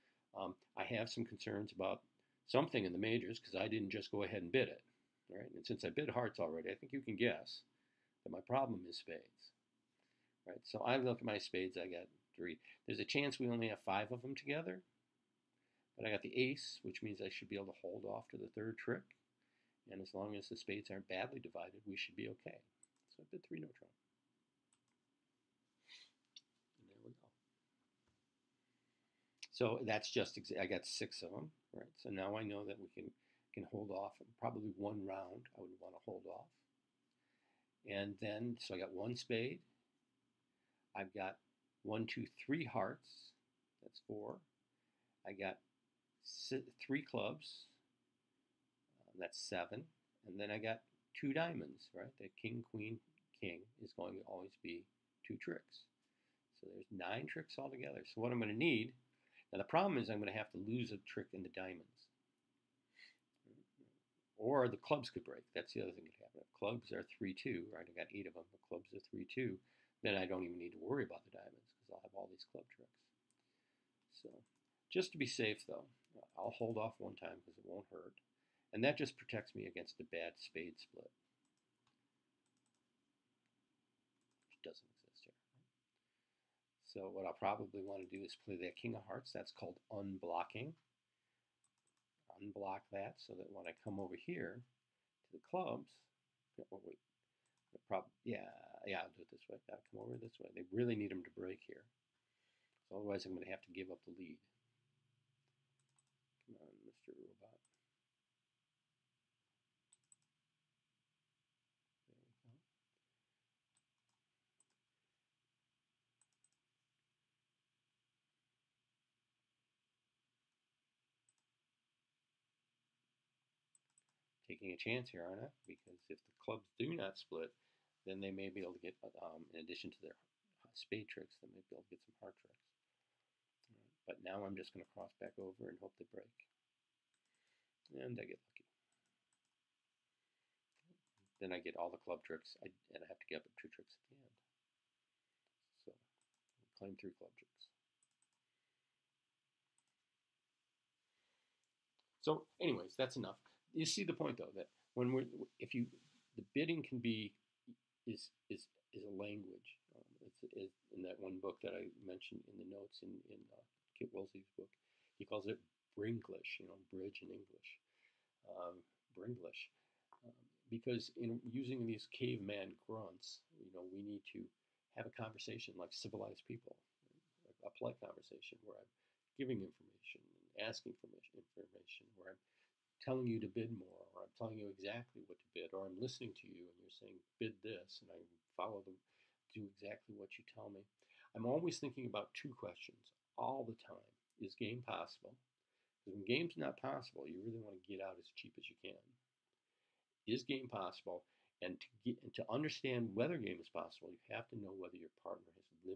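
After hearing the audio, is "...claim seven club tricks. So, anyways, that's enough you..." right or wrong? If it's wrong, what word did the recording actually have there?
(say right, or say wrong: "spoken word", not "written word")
wrong: "three", not "seven".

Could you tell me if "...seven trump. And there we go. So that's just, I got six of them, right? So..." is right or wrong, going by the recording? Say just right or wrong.
wrong.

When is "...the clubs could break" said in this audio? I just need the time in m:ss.
1:04.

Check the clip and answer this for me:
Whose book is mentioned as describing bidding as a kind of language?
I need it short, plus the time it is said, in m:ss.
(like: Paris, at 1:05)
Kit Woolsey, at 2:43.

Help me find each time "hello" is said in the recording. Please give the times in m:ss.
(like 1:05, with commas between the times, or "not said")
not said.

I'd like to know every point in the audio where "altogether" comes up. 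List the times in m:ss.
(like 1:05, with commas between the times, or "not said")
0:57.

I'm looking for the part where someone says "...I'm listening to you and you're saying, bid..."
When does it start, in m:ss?
3:05.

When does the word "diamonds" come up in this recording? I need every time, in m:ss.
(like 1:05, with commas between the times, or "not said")
0:51, 1:01, 1:11.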